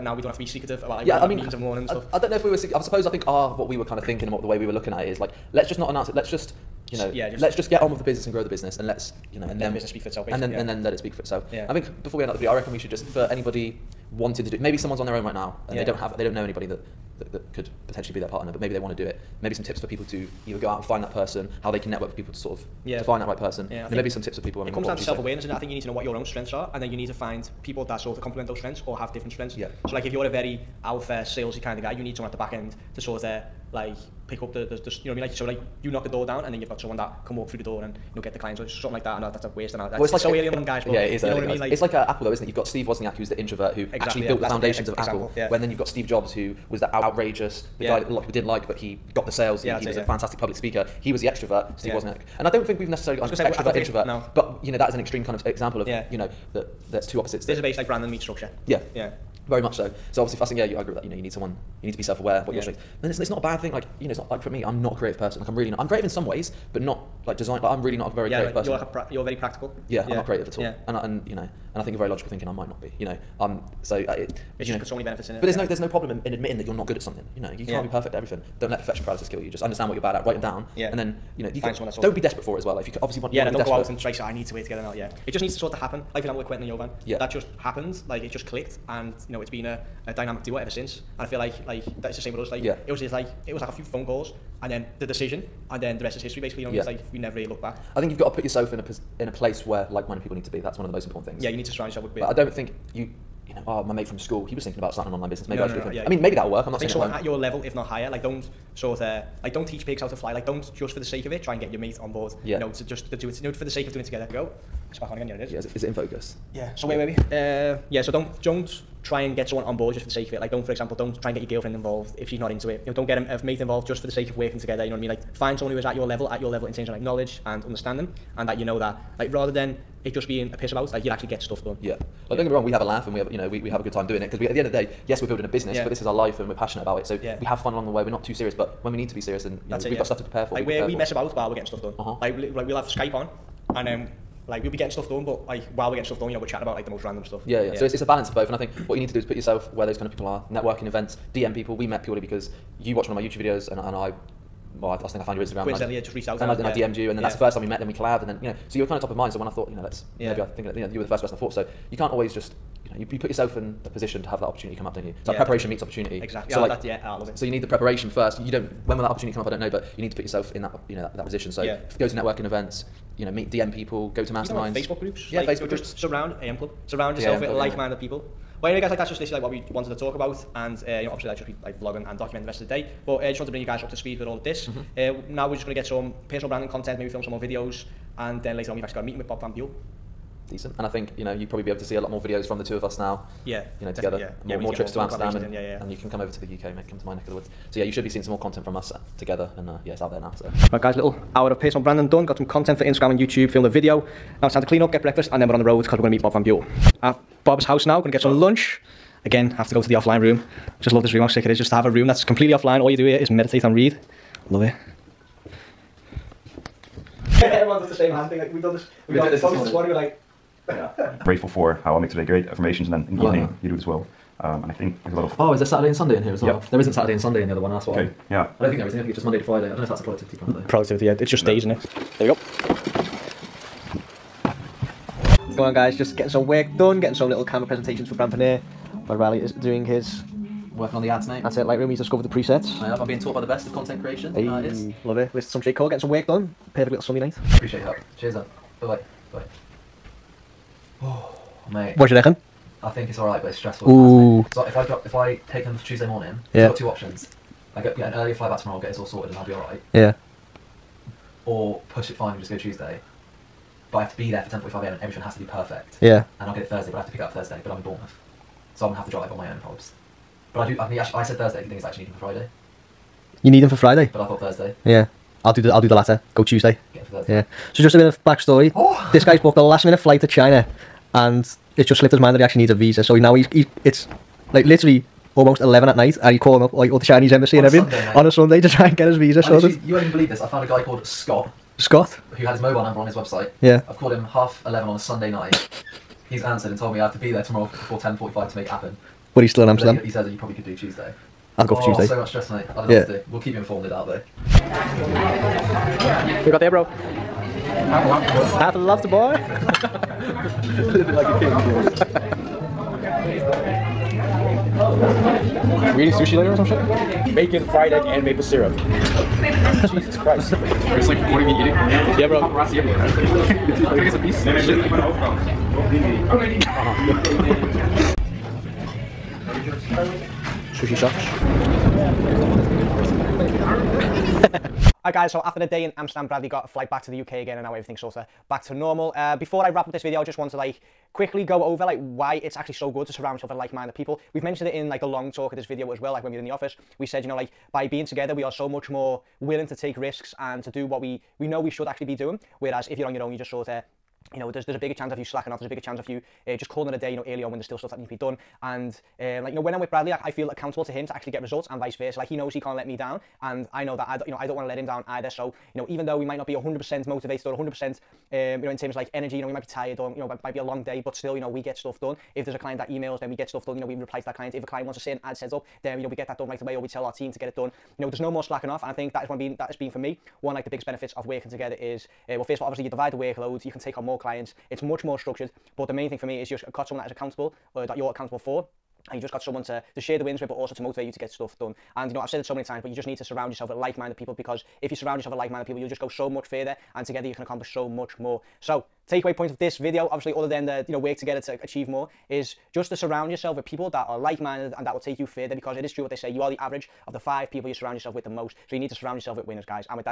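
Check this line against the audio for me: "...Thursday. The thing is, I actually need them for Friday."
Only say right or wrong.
right.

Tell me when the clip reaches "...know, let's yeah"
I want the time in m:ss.
2:39.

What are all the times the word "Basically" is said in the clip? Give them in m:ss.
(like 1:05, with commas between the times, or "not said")
0:10, 1:36.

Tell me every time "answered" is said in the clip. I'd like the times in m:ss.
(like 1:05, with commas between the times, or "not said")
4:56.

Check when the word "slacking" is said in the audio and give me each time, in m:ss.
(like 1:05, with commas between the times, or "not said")
5:55, 6:18.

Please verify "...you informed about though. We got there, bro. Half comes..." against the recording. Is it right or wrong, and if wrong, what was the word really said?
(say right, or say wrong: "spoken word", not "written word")
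wrong: "loves", not "comes".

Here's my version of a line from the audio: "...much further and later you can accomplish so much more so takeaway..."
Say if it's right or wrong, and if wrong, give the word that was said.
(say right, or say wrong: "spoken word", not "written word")
wrong: "together", not "later".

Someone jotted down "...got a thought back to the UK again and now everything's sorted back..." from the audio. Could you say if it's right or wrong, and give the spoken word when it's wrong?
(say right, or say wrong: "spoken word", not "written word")
wrong: "flight", not "thought".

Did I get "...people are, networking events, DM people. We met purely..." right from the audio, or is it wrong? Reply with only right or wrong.
right.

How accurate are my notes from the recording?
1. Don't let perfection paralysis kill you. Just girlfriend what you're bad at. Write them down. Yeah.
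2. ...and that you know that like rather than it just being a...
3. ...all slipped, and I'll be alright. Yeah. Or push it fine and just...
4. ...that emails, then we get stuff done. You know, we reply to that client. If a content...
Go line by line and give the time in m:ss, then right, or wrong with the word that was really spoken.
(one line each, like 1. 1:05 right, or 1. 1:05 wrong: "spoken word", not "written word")
1. 1:18 wrong: "understand", not "girlfriend"
2. 2:08 right
3. 4:18 wrong: "sorted", not "slipped"
4. 6:12 wrong: "client", not "content".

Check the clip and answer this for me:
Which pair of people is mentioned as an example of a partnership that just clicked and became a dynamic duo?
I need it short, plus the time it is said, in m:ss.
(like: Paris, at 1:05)
Quentin and Jovan, at 1:26.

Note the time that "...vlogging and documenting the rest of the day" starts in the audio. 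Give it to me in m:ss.
3:01.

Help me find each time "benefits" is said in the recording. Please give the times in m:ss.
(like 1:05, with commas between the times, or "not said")
1:15, 6:20.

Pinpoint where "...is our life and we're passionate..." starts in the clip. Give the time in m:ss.
2:16.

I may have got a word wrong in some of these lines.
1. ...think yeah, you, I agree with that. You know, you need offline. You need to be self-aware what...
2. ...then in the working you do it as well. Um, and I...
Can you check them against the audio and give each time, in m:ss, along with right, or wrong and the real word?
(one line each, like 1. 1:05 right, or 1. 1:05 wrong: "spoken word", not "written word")
1. 1:00 wrong: "someone", not "offline"
2. 3:42 wrong: "evening", not "working".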